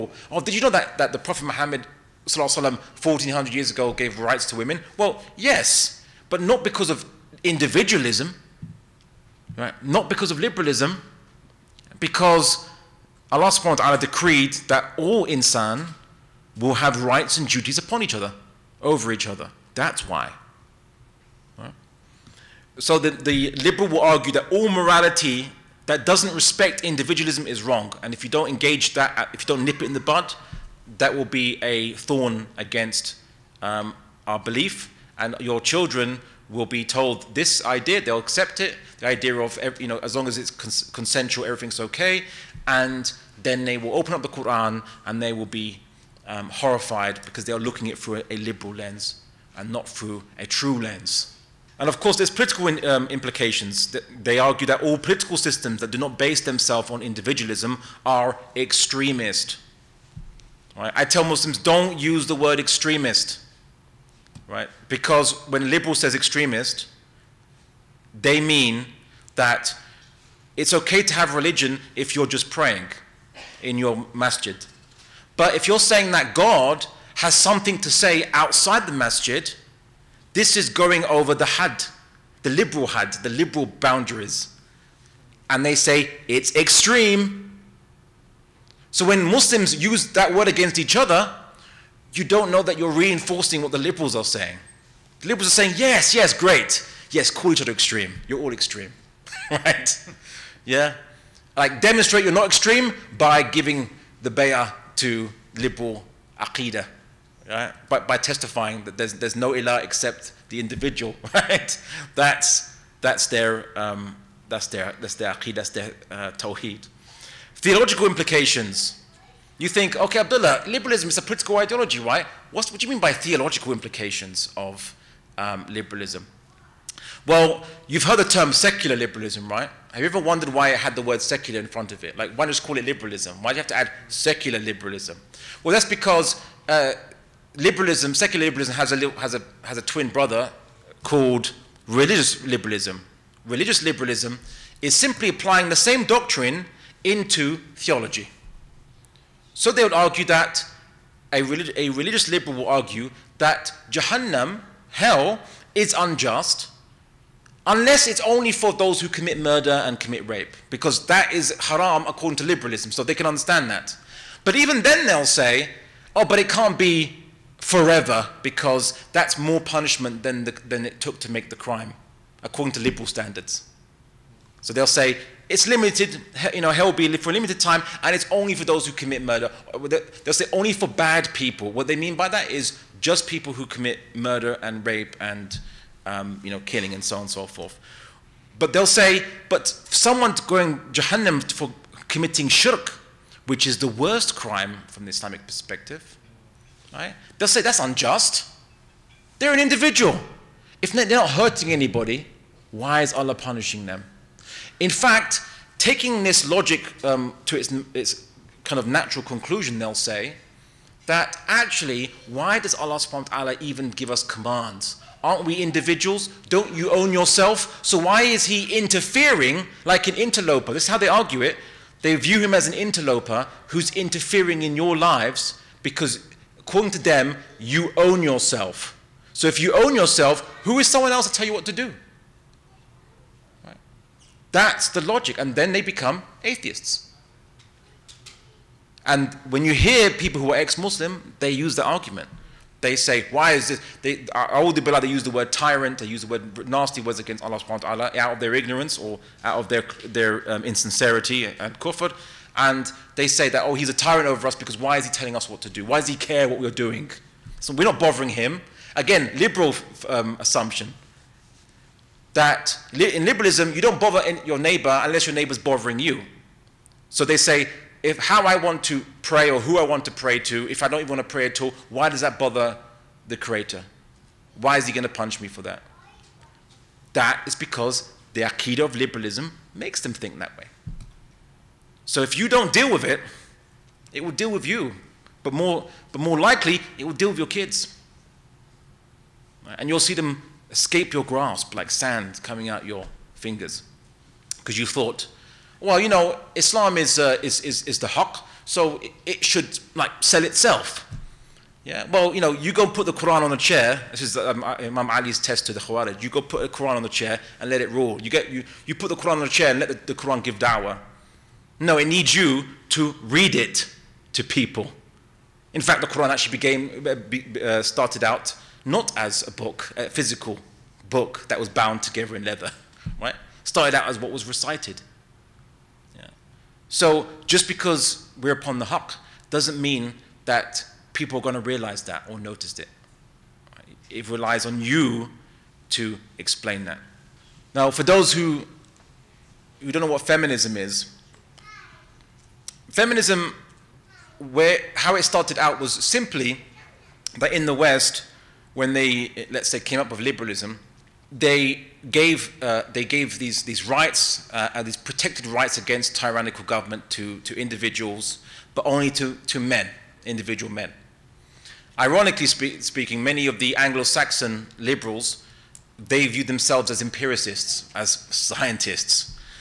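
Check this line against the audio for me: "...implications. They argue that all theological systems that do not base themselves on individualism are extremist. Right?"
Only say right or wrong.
wrong.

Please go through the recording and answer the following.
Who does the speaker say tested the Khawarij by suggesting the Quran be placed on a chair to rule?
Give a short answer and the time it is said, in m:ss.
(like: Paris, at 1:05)
Imam Ali, at 5:04.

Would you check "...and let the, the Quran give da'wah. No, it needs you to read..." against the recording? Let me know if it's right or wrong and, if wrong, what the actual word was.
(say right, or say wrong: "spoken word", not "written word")
right.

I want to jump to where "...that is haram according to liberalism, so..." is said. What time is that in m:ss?
2:41.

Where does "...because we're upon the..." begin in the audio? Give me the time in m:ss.
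5:27.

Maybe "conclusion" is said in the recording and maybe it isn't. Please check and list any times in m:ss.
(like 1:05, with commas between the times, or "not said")
3:29.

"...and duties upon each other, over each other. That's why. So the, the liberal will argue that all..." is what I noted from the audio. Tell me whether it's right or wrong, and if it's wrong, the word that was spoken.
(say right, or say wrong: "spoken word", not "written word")
right.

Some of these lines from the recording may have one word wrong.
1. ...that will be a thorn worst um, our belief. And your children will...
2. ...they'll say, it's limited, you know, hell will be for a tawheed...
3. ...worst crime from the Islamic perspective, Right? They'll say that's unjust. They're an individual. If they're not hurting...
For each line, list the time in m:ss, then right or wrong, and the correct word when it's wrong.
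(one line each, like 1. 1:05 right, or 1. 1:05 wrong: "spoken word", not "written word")
1. 0:30 wrong: "against", not "worst"
2. 2:54 wrong: "limited", not "tawheed"
3. 3:13 right.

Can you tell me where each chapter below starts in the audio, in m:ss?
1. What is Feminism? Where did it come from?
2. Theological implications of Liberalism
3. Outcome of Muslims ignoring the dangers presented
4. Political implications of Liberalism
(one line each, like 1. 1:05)
1. 5:37
2. 1:57
3. 4:40
4. 0:51.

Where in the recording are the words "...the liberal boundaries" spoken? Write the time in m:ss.
1:23.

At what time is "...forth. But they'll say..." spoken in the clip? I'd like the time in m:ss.
3:07.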